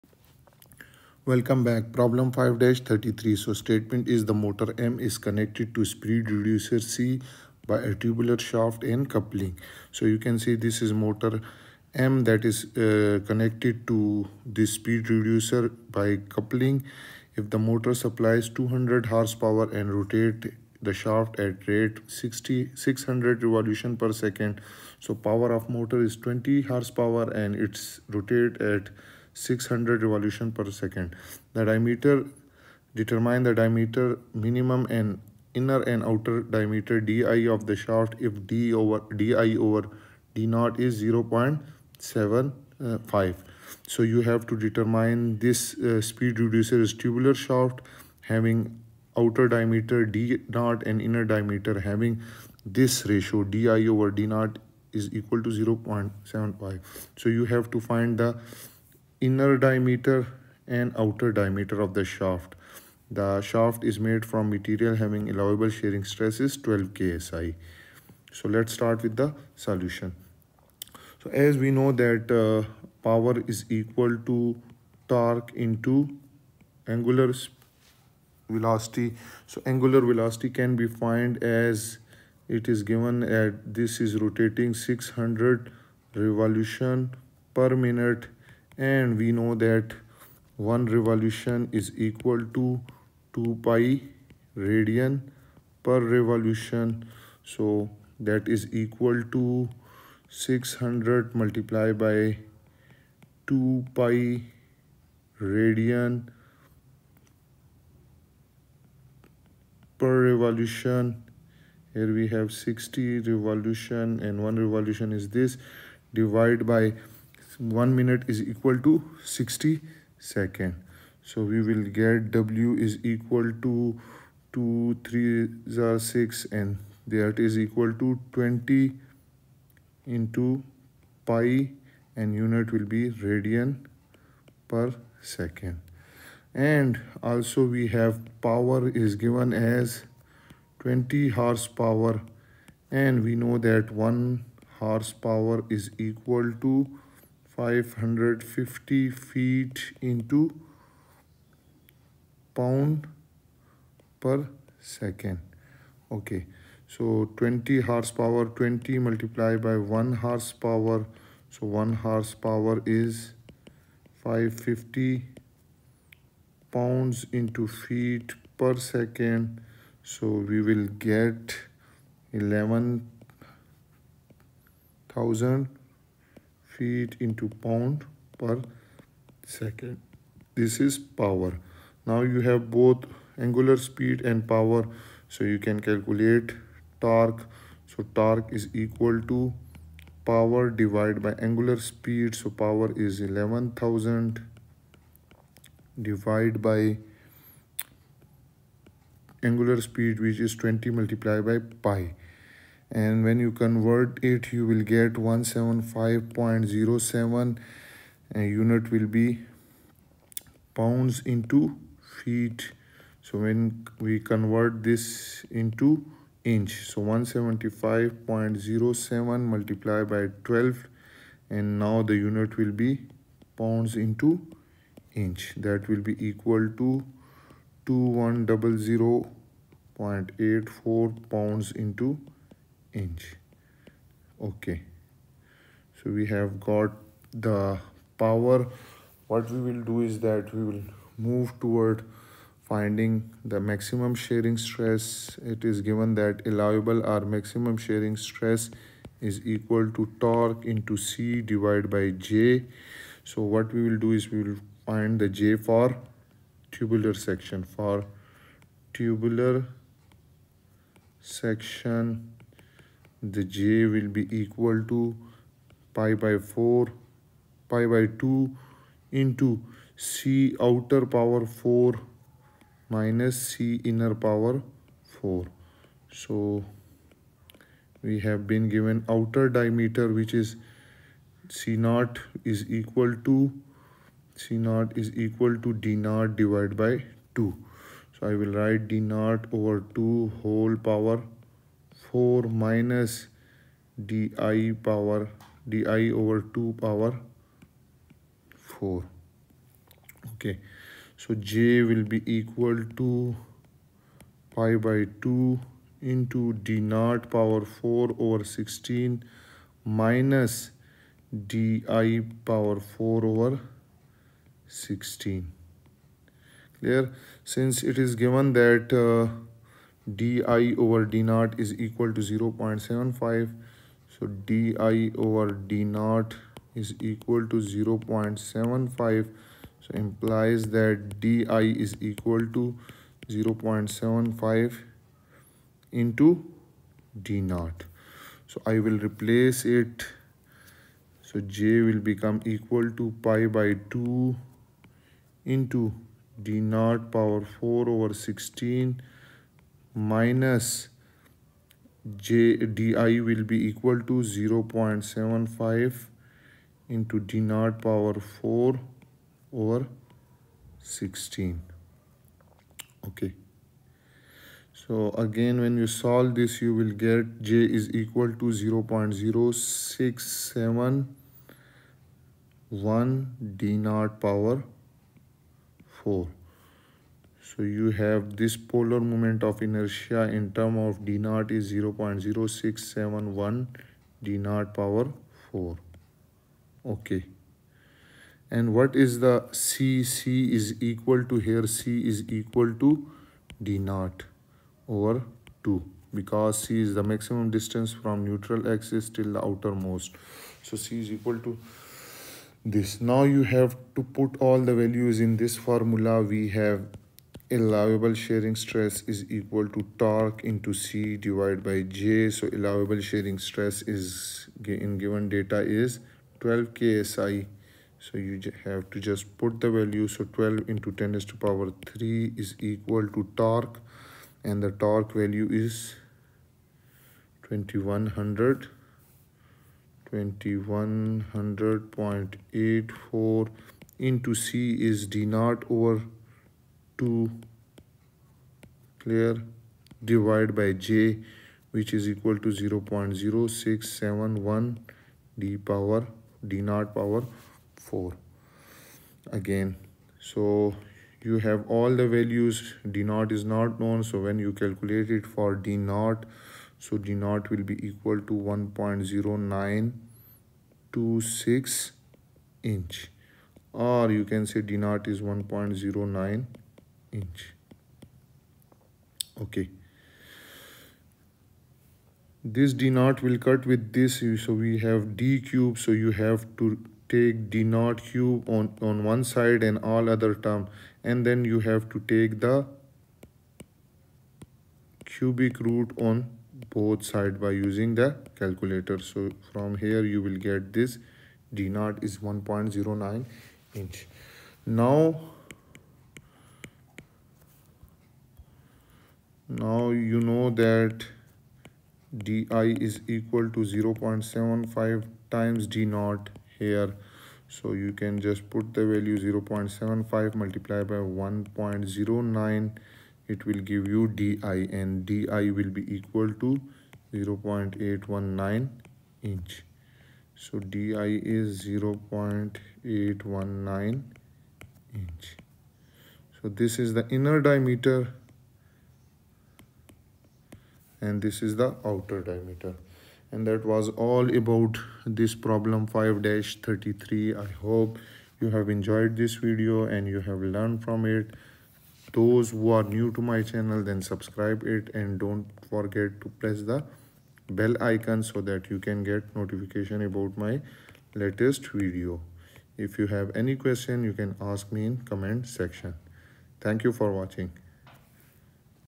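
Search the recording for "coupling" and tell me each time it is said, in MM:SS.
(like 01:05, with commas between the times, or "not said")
00:09, 00:16.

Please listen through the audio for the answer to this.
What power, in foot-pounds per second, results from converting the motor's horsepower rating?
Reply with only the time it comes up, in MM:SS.
02:52.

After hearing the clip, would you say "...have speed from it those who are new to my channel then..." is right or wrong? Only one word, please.
wrong.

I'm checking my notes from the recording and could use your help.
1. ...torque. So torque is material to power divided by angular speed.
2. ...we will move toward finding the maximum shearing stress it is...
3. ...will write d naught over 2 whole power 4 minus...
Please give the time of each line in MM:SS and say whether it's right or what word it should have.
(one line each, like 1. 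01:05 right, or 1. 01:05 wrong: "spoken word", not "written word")
1. 03:06 wrong: "equal", not "material"
2. 04:00 right
3. 04:48 right.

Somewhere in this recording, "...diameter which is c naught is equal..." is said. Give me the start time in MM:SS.
04:39.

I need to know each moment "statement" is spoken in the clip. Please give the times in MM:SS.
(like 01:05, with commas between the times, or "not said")
00:03.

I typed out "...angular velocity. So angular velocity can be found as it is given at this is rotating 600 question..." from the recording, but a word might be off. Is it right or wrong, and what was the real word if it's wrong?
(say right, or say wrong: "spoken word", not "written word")
wrong: "revolution", not "question".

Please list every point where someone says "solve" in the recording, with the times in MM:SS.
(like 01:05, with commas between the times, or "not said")
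06:05.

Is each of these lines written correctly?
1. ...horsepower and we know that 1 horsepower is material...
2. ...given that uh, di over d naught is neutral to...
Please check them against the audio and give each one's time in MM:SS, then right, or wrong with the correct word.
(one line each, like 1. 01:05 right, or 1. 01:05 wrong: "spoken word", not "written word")
1. 02:21 wrong: "equal", not "material"
2. 05:18 wrong: "equal", not "neutral".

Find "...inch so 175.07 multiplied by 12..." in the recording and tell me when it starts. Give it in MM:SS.
03:36.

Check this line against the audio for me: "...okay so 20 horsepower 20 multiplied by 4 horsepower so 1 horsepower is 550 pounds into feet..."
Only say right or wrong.
wrong.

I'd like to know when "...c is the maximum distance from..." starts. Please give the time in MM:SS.
06:36.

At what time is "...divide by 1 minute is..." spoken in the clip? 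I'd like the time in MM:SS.
01:56.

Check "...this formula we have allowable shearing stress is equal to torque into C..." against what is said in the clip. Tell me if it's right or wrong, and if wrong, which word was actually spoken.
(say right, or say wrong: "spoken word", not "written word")
right.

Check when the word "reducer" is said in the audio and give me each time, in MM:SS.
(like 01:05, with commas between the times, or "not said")
00:06, 00:15, 00:46.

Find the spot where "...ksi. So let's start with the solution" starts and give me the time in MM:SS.
01:06.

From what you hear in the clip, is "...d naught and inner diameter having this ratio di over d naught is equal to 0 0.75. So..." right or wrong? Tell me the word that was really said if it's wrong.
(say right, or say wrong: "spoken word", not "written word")
right.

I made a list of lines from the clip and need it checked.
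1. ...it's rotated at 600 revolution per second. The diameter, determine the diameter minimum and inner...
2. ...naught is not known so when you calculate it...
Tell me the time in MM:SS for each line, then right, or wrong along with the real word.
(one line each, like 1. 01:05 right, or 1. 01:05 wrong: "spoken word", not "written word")
1. 00:27 right
2. 07:33 right.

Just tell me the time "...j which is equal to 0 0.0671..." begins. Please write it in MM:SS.
07:20.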